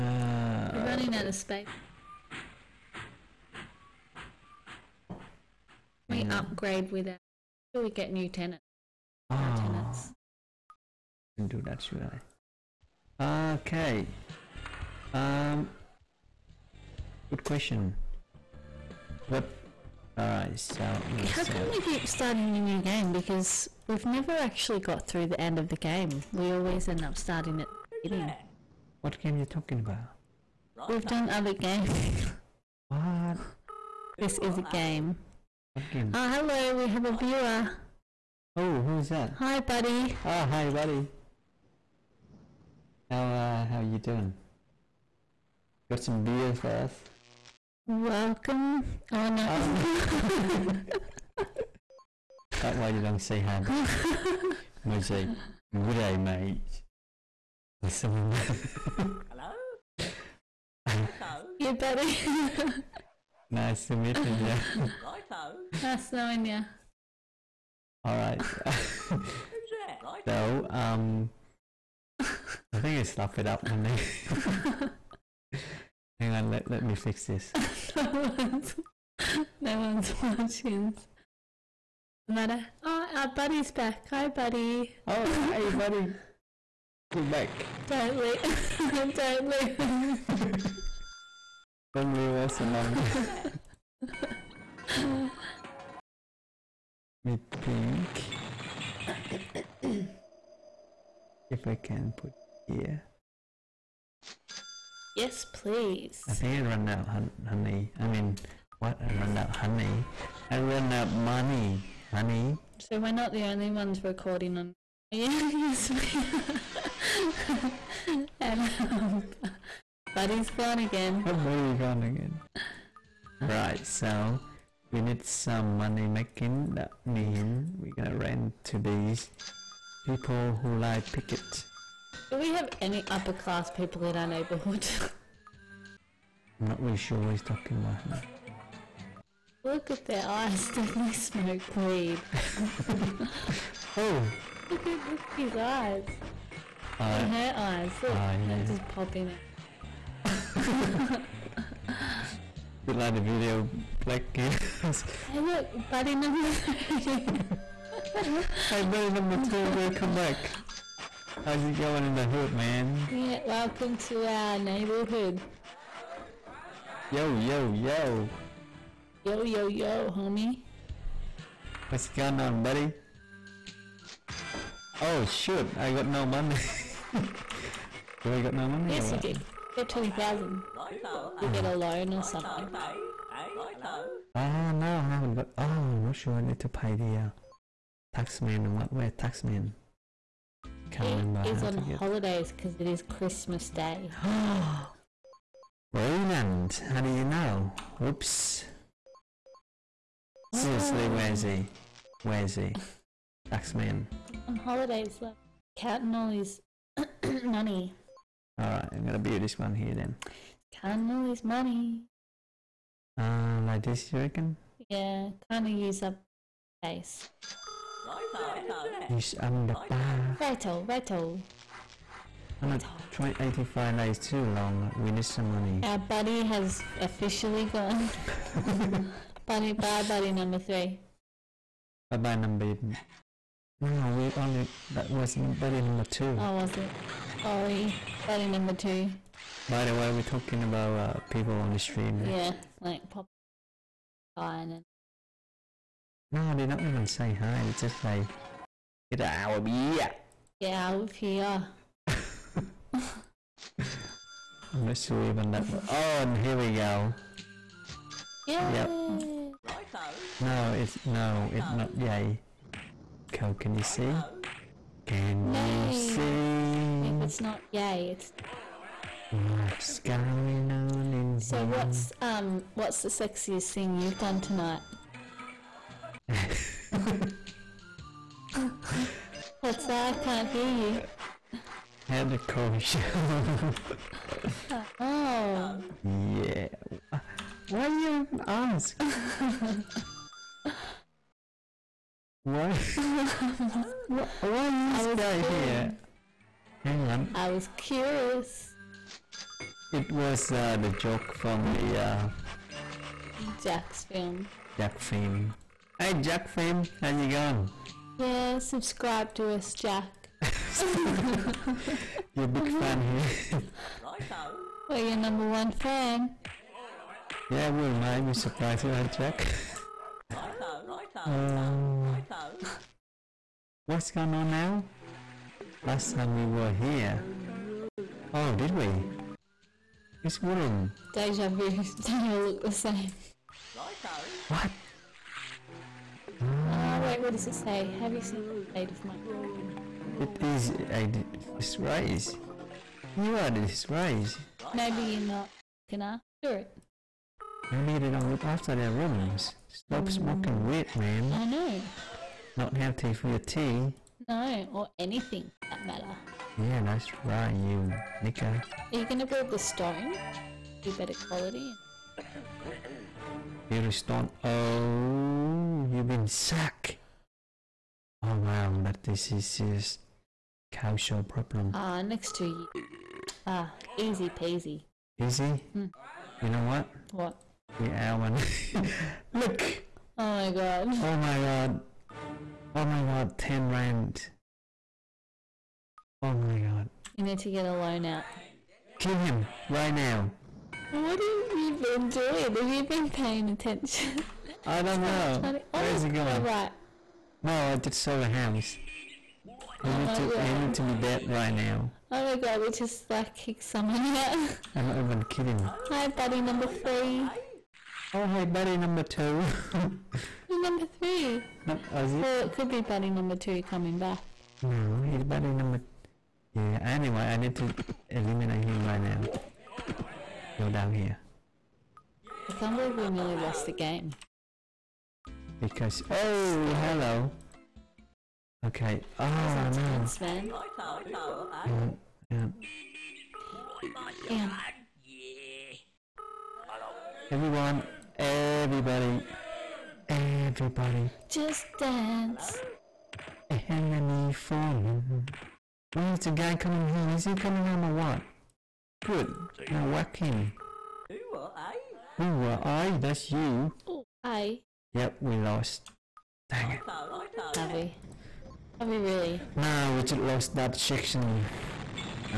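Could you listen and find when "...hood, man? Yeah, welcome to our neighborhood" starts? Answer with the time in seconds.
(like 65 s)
162 s.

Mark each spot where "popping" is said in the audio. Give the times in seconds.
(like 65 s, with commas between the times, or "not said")
148 s.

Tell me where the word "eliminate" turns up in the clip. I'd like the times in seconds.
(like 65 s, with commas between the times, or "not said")
418 s.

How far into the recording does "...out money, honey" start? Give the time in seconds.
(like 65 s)
110 s.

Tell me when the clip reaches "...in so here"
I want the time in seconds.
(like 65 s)
271 s.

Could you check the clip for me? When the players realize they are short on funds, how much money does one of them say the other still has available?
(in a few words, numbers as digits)
20,000.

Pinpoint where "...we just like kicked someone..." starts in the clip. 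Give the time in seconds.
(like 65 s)
402 s.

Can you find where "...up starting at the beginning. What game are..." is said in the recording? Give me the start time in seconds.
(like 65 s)
27 s.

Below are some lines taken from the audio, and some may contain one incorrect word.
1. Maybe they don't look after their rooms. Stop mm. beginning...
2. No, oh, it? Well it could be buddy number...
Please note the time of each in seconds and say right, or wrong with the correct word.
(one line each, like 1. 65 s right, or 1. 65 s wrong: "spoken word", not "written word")
1. 347 s wrong: "smoking", not "beginning"
2. 411 s right.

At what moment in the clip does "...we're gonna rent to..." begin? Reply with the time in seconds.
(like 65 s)
127 s.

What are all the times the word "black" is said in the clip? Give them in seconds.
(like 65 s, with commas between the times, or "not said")
154 s.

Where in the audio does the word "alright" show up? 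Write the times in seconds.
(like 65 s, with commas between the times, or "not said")
20 s, 208 s.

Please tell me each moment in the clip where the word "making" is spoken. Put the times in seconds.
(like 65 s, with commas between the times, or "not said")
126 s.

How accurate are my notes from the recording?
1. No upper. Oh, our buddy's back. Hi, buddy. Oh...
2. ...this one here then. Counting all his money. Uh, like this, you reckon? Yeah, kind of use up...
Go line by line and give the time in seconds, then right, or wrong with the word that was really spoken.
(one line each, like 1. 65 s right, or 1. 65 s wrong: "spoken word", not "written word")
1. 82 s wrong: "matter", not "upper"
2. 209 s right.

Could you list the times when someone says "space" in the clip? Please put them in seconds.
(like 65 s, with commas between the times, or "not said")
1 s, 216 s.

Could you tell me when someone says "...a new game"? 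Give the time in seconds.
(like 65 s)
22 s.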